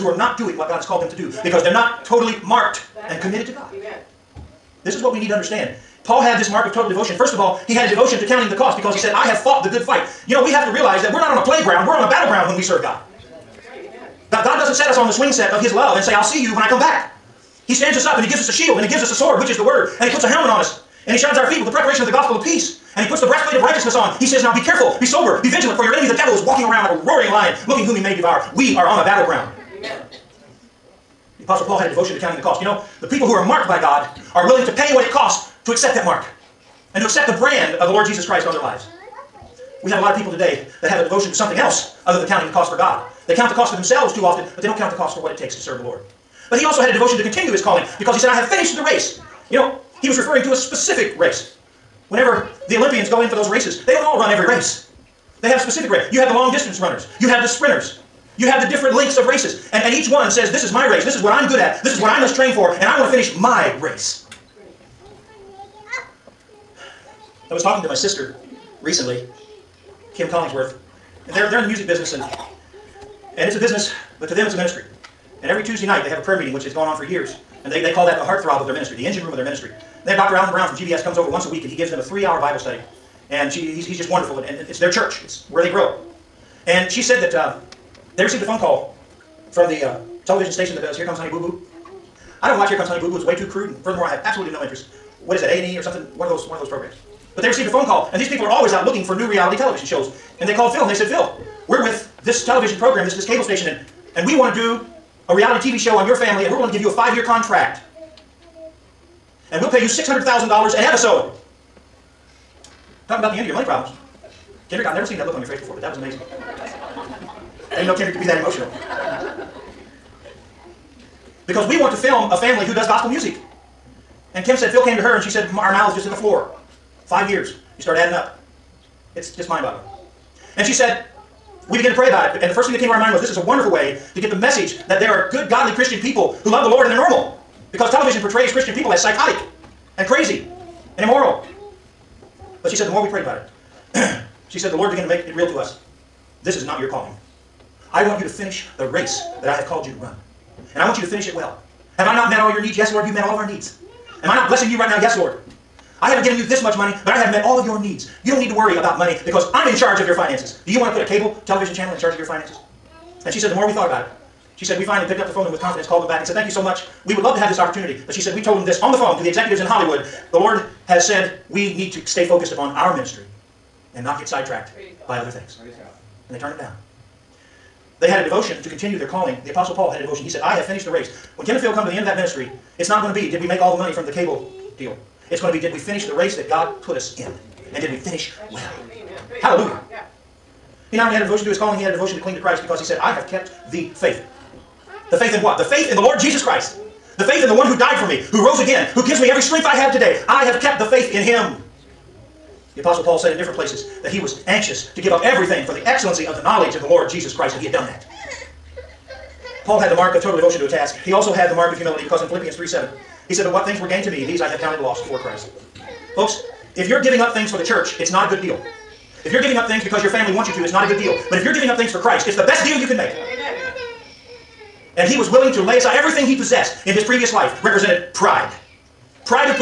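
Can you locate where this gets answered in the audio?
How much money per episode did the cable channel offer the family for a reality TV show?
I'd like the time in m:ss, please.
1:49.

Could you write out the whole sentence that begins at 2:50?
The Lord has said we need to stay focused upon our ministry and not get sidetracked by other things.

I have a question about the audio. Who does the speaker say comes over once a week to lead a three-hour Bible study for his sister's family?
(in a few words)
Dr. Alan Brown.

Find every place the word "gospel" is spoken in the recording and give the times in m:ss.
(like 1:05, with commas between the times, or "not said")
0:22, 2:02.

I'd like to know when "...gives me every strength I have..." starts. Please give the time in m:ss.
3:19.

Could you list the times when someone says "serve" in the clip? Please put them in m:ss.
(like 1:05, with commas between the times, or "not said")
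0:12, 0:45.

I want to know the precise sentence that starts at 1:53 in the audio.
Talking about the end of your money problems.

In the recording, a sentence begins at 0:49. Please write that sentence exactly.
You know, he was referring to a specific race.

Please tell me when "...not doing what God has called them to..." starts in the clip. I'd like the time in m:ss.
0:00.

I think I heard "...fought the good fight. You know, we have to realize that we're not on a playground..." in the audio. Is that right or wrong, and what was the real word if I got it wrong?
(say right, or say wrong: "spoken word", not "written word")
right.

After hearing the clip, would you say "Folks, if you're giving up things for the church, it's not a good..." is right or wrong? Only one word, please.
right.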